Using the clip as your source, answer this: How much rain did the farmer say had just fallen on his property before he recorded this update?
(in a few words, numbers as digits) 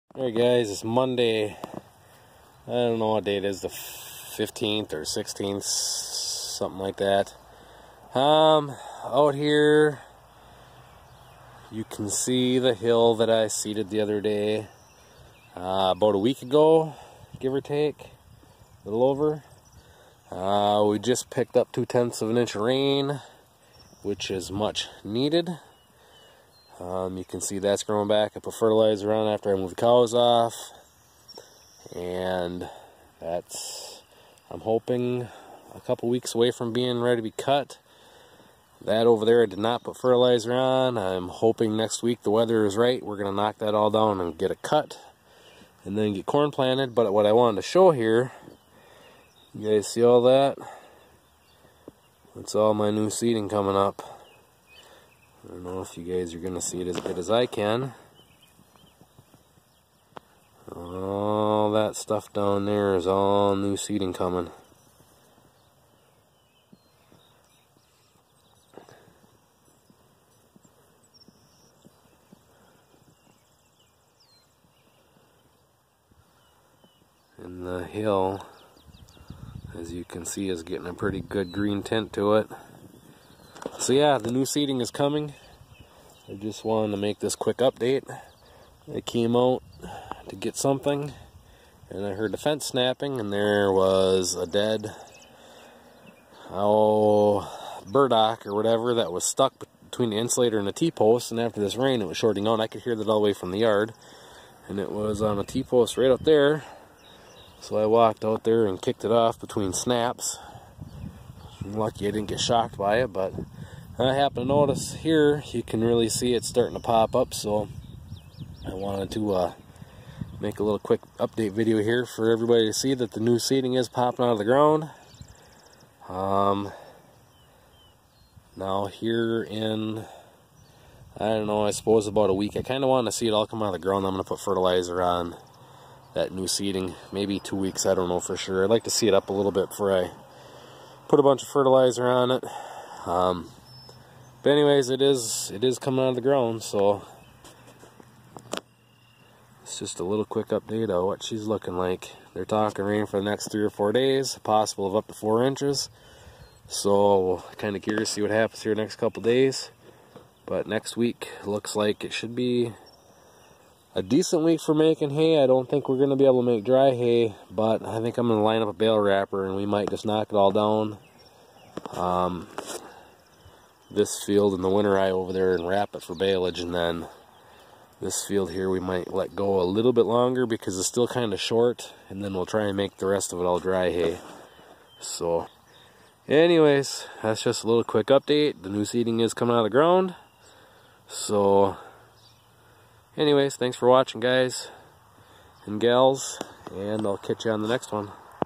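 0.2 inch.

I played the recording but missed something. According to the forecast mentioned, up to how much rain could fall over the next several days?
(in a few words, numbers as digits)
4 inches.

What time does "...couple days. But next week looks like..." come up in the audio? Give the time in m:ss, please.
2:38.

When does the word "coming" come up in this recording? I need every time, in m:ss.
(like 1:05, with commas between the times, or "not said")
0:53, 1:04, 1:24, 2:25, 3:09.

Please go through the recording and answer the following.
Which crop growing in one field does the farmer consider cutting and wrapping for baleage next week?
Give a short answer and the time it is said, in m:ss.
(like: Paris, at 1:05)
winter rye, at 2:54.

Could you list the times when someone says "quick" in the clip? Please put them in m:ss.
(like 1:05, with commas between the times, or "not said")
1:27, 2:00, 2:30, 3:07.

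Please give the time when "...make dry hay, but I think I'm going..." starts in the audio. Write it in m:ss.
2:46.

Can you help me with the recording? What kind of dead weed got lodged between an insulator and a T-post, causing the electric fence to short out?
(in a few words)
burdock.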